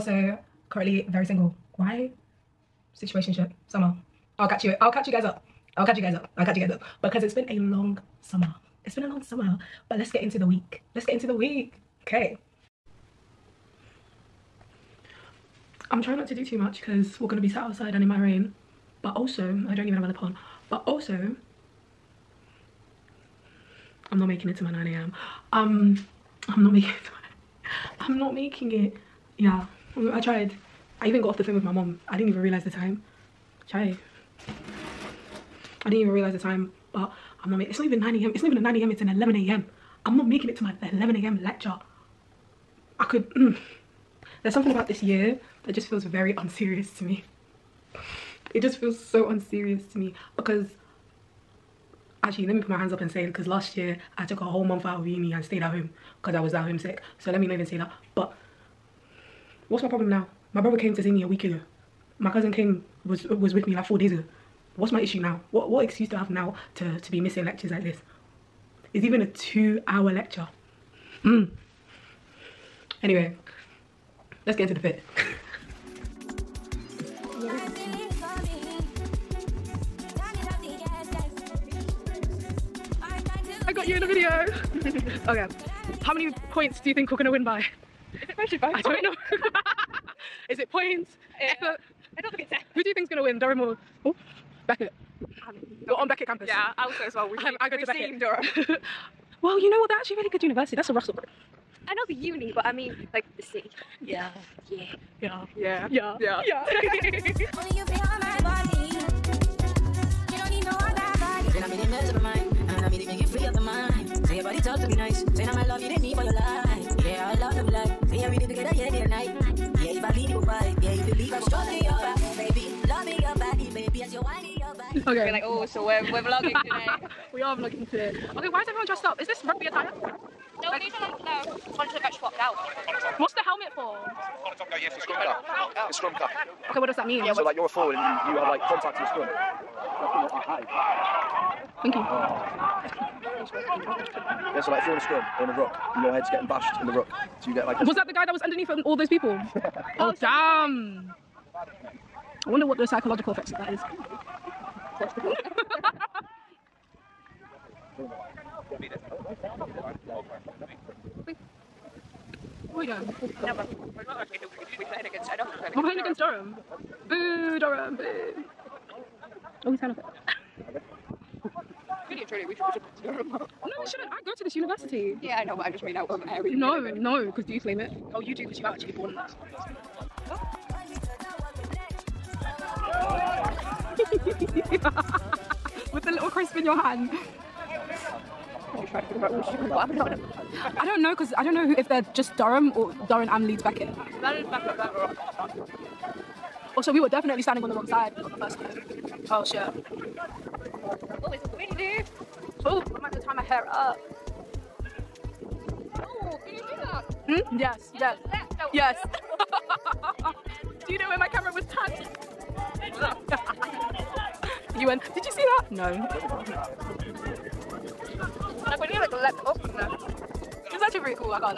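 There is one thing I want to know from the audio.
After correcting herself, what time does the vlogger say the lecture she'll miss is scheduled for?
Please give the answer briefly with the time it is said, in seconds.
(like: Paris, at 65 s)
11 a.m., at 38 s.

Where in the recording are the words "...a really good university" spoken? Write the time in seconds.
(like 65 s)
100 s.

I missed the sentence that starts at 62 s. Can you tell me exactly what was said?
My cousin came was was with me like four days ago what's my issue now?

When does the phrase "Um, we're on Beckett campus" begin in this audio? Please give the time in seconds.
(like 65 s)
95 s.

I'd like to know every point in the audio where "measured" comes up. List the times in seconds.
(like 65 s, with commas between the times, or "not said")
88 s.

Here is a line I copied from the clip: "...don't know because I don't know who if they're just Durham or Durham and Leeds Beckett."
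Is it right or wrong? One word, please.
right.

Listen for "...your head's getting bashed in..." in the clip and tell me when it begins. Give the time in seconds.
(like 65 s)
146 s.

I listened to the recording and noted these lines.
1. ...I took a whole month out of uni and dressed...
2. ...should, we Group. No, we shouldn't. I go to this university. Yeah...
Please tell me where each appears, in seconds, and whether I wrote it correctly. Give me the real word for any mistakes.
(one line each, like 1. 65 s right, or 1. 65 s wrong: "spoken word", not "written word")
1. 54 s wrong: "stayed", not "dressed"
2. 172 s wrong: "Durham", not "Group".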